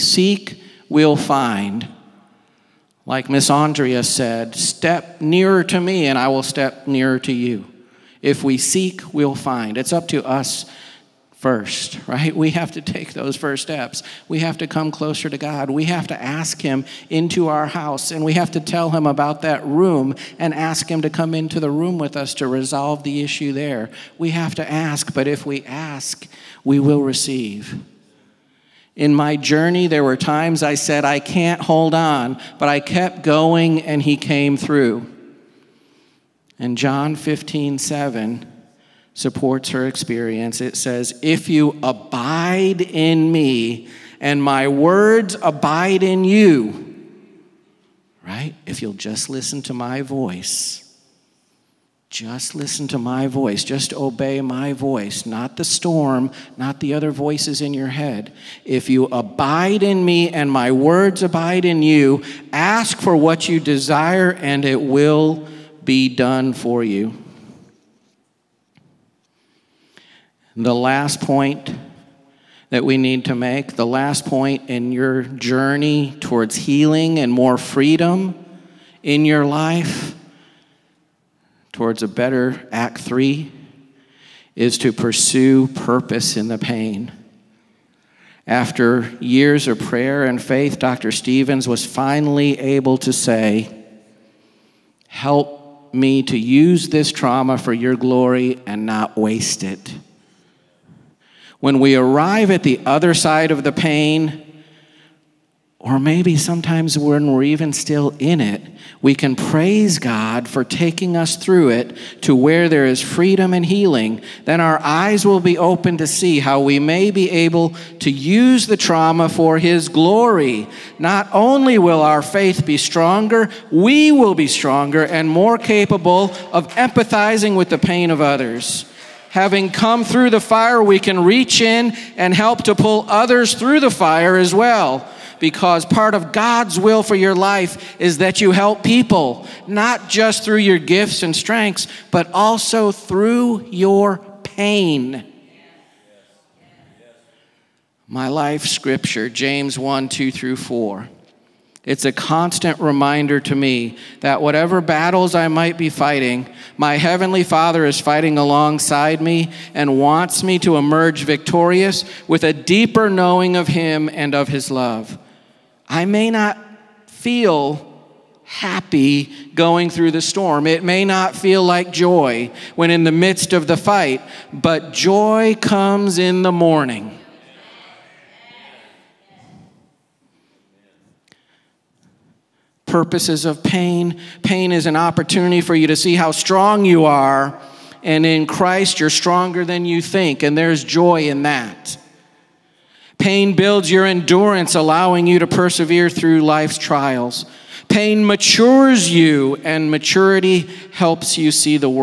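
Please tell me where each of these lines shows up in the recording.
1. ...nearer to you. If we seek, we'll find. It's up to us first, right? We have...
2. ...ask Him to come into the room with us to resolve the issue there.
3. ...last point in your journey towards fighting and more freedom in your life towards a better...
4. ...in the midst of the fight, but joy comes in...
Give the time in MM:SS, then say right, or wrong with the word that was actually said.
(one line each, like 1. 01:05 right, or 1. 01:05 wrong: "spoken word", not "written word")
1. 00:06 right
2. 00:20 right
3. 01:13 wrong: "healing", not "fighting"
4. 02:52 right.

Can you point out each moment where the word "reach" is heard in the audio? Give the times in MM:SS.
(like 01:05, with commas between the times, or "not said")
02:11.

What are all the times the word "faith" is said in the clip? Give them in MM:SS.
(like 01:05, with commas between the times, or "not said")
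01:30, 02:02.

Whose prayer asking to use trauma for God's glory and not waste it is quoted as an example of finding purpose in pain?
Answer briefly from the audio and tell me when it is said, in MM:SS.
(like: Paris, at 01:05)
Dr. Stevens, at 01:30.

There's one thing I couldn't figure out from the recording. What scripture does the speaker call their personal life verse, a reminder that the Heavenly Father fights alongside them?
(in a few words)
James 1:2-4.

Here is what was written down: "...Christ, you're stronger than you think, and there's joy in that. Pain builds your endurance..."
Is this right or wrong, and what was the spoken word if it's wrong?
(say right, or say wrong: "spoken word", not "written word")
right.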